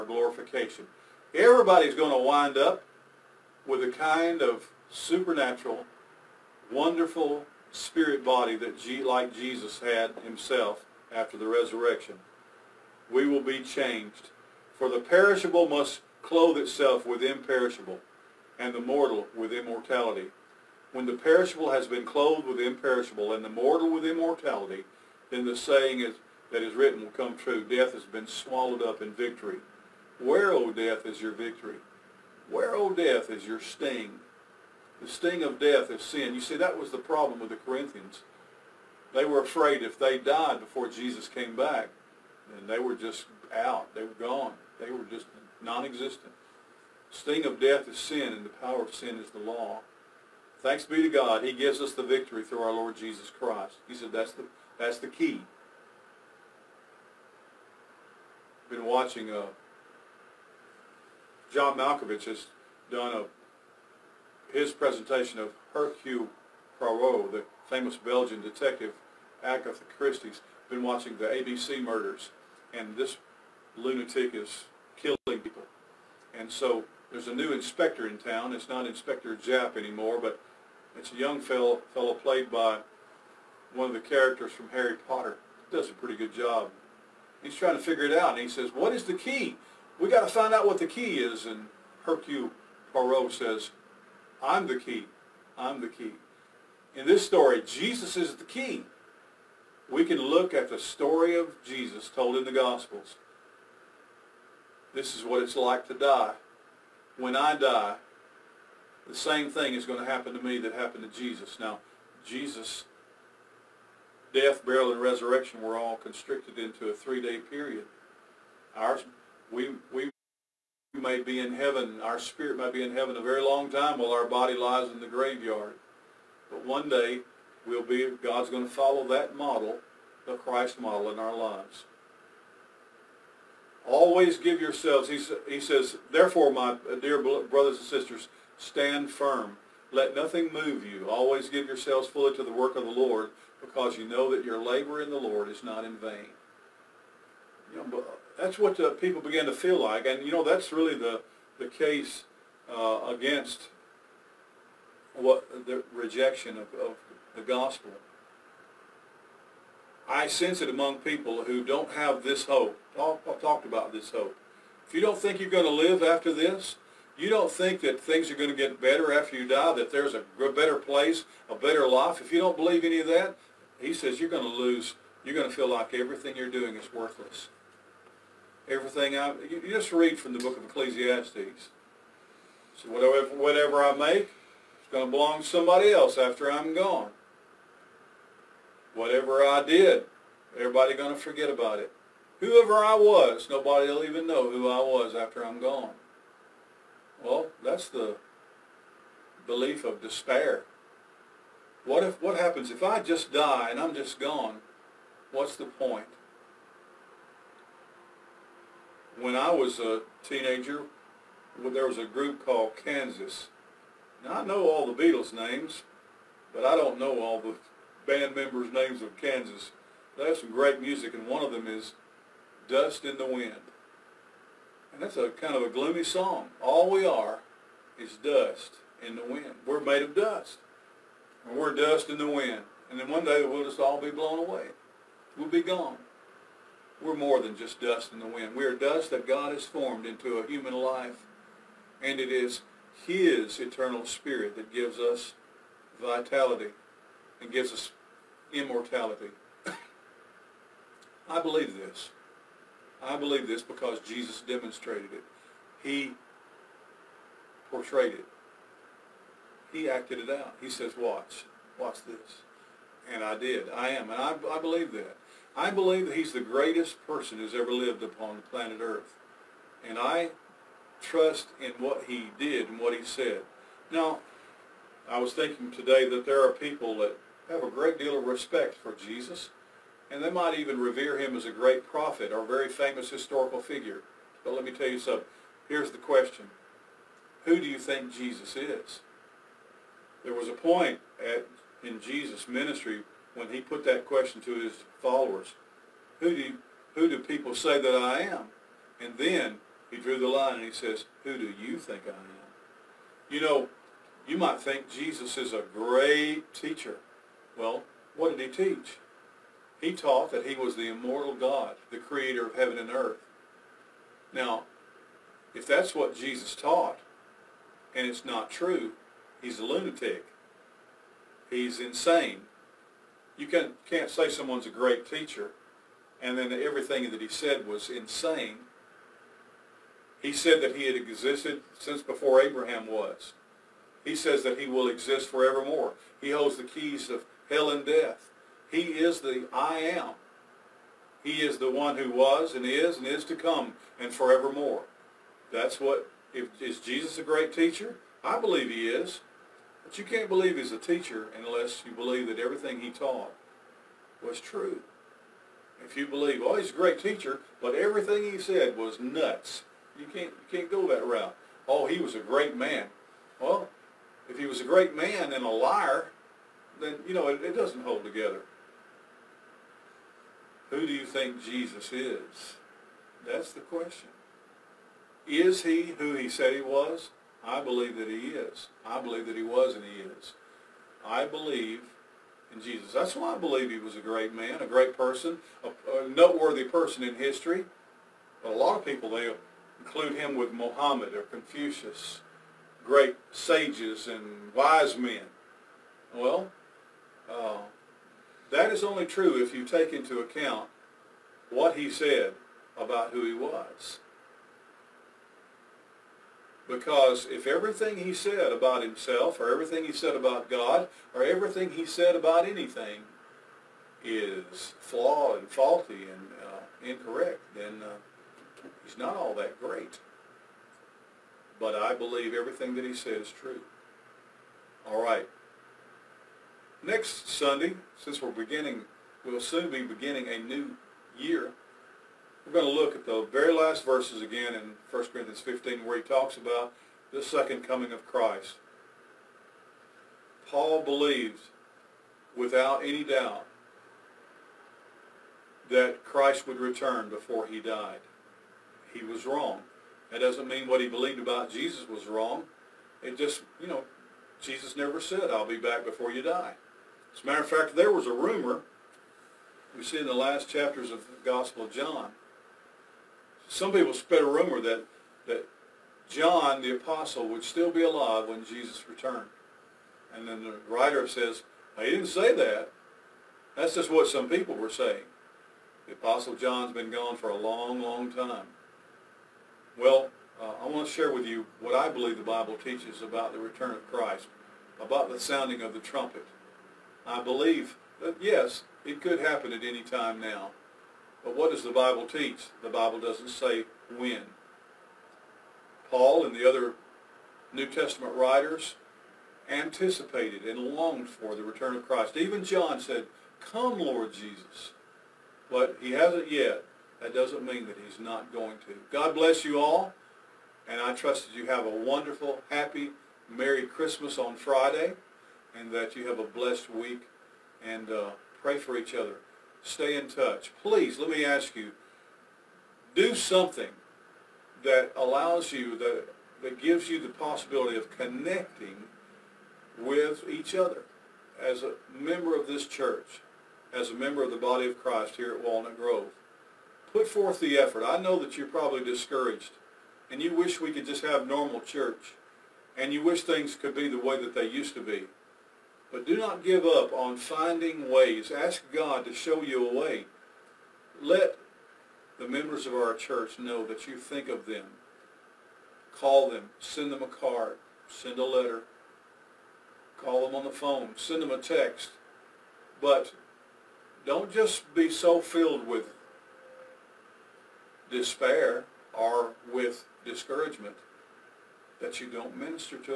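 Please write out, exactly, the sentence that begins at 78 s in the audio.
It's not Inspector Japp anymore, but it's a young fellow, fellow played by one of the characters from Harry Potter.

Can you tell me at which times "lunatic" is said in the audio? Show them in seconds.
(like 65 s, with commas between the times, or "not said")
73 s, 319 s.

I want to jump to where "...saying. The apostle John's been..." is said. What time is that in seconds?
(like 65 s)
474 s.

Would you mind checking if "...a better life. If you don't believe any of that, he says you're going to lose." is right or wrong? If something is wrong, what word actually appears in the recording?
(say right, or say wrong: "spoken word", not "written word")
right.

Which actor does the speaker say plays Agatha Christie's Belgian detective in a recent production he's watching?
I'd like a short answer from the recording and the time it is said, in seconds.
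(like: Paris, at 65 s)
John Malkovich, at 61 s.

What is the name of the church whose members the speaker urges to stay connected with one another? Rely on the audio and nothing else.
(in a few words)
Walnut Grove.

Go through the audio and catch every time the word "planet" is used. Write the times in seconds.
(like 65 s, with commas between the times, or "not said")
268 s.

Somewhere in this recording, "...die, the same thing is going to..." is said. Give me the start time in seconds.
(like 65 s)
107 s.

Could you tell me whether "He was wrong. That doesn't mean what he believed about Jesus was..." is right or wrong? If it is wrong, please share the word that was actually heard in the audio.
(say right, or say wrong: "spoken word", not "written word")
right.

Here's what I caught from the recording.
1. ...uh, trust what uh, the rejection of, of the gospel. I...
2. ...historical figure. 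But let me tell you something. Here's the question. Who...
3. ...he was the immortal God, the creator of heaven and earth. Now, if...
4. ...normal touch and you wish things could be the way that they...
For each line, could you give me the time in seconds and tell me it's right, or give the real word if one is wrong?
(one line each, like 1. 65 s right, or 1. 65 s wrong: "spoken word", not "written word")
1. 152 s wrong: "against", not "trust"
2. 283 s right
3. 310 s right
4. 541 s wrong: "church", not "touch".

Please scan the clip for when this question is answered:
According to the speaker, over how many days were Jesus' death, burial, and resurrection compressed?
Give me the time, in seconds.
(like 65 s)
116 s.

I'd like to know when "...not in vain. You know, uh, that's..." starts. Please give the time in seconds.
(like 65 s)
145 s.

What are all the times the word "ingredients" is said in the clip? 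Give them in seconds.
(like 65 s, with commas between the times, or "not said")
not said.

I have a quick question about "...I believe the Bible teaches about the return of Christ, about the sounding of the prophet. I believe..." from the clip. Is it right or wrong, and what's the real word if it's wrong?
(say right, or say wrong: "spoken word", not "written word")
wrong: "trumpet", not "prophet".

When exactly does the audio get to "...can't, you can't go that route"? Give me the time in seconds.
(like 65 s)
360 s.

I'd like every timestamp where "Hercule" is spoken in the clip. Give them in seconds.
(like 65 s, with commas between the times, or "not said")
65 s, 92 s.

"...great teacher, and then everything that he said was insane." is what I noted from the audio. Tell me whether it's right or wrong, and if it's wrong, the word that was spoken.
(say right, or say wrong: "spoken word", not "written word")
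right.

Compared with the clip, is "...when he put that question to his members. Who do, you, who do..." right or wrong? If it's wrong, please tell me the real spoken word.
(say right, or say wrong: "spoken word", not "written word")
wrong: "followers", not "members".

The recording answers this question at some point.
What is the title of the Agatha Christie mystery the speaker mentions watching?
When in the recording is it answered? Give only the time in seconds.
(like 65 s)
71 s.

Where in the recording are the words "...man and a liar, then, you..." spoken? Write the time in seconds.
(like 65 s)
364 s.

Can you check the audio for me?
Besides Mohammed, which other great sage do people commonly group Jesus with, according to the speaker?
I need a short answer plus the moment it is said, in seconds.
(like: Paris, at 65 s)
Confucius, at 391 s.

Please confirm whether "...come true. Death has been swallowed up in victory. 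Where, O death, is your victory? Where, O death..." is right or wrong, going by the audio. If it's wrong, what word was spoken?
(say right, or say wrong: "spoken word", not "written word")
right.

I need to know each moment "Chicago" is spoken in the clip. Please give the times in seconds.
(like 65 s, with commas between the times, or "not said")
not said.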